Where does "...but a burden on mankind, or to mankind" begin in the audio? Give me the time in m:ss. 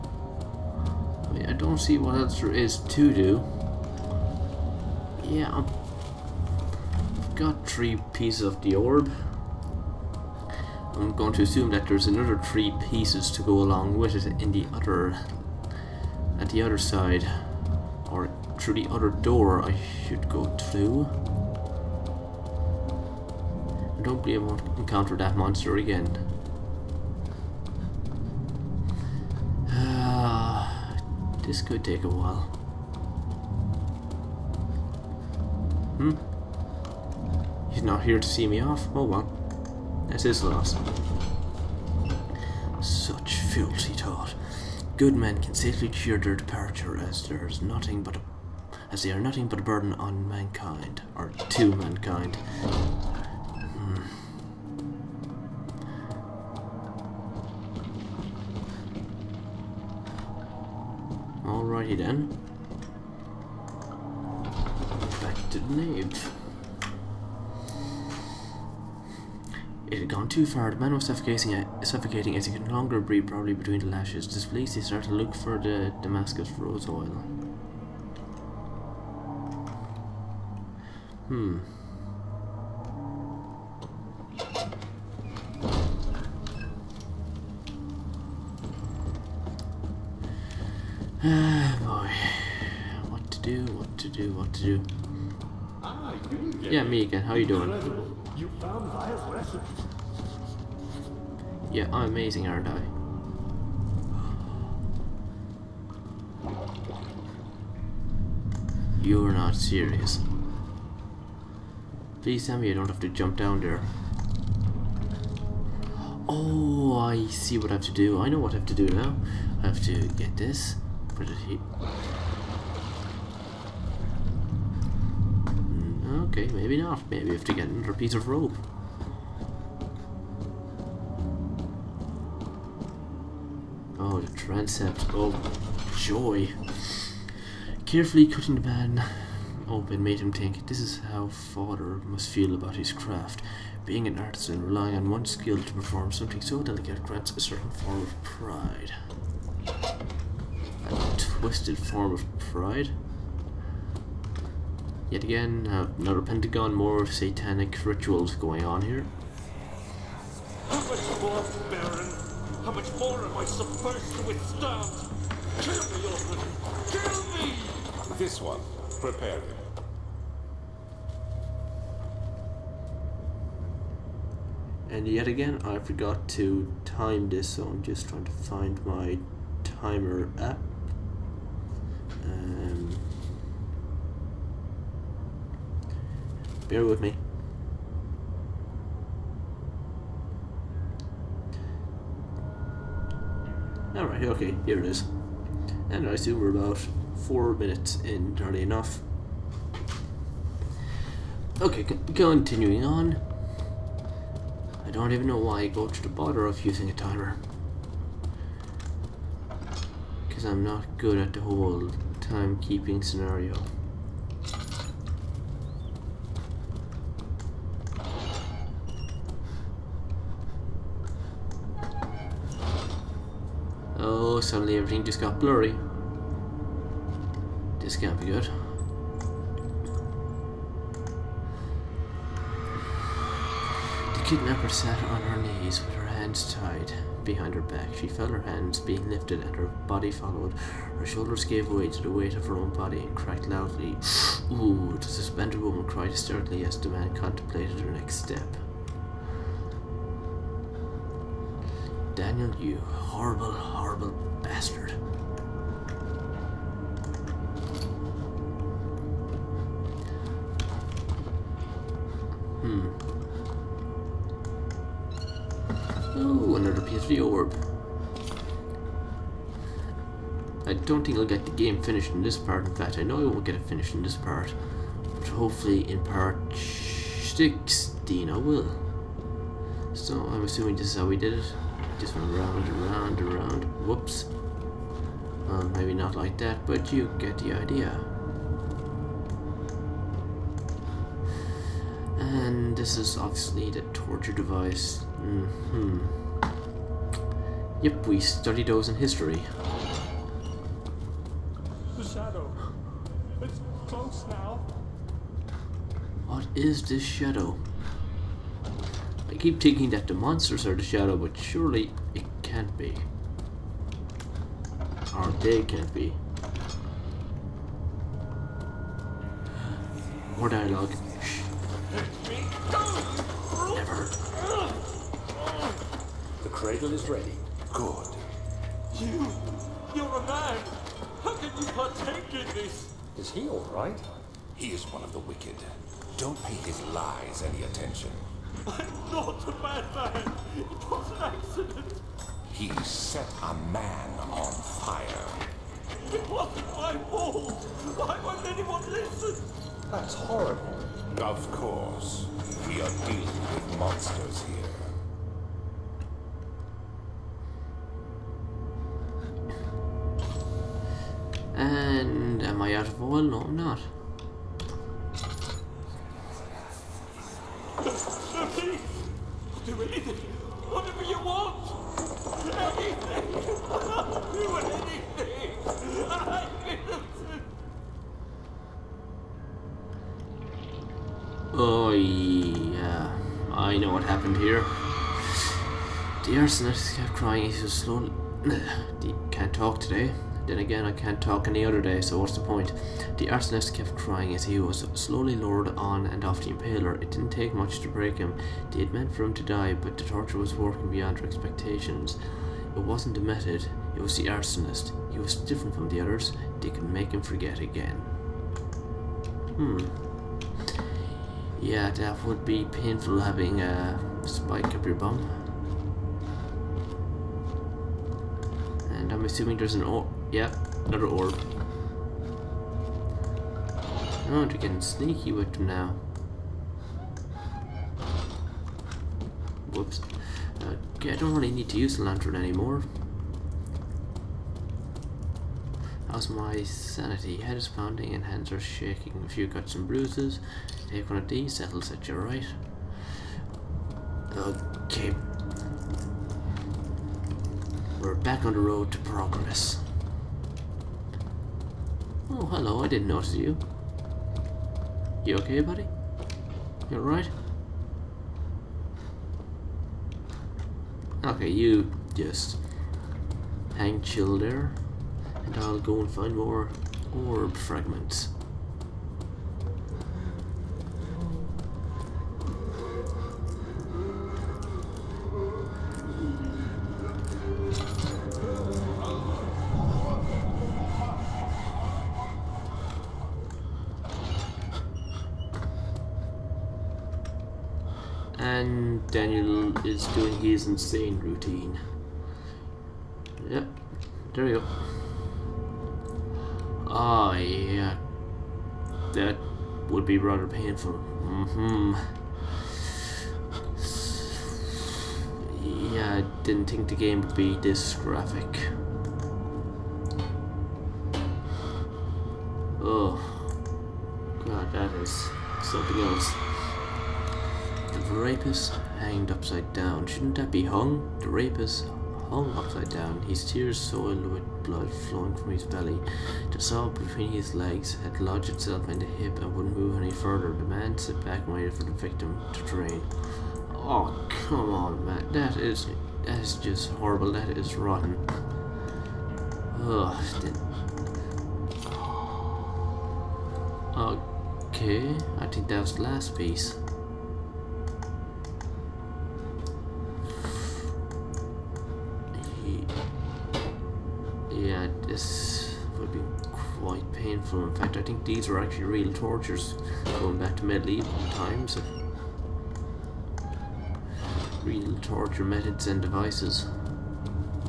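0:49.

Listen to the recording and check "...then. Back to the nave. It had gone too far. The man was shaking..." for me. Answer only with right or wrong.
wrong.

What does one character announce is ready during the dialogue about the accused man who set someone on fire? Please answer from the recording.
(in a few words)
The cradle.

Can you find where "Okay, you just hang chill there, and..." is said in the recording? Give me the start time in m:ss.
7:41.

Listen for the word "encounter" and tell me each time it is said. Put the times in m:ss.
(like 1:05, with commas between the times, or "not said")
0:24.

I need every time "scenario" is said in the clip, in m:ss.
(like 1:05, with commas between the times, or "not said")
3:33.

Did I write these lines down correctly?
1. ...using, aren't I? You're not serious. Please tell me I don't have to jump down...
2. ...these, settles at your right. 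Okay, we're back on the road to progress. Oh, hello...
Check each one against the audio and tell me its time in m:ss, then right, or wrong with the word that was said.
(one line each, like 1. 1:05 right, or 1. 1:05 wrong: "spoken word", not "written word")
1. 1:42 wrong: "amazing", not "using"
2. 7:21 right.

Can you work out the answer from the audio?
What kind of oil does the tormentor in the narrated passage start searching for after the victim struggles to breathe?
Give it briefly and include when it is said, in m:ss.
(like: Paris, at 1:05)
Damascus rose oil, at 1:16.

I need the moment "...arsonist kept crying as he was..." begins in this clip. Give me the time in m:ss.
6:33.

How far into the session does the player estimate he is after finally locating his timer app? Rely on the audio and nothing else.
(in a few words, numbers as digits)
4 minutes.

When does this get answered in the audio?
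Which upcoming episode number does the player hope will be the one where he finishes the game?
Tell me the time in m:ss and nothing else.
4:36.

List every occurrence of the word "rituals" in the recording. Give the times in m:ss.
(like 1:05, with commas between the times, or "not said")
2:37.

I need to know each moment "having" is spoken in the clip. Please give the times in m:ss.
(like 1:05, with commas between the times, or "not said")
6:53.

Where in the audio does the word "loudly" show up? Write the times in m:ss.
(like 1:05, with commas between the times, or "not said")
4:03.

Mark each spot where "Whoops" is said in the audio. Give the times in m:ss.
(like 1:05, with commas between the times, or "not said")
4:43, 7:09.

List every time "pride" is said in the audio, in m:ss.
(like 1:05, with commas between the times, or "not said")
2:28, 2:32.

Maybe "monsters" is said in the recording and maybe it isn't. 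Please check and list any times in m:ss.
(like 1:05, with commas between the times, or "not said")
0:25, 5:10, 5:53.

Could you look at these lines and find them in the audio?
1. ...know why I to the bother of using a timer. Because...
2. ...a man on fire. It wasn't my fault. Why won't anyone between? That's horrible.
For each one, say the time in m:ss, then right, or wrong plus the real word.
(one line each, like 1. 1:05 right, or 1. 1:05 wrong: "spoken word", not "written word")
1. 3:25 right
2. 5:43 wrong: "listen", not "between".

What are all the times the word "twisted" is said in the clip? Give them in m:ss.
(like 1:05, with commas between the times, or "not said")
2:31.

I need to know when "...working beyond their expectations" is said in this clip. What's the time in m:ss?
6:40.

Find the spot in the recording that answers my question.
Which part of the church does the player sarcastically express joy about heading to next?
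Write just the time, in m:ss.
2:14.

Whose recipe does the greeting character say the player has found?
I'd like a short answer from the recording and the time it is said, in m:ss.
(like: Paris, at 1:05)
Maya's, at 1:38.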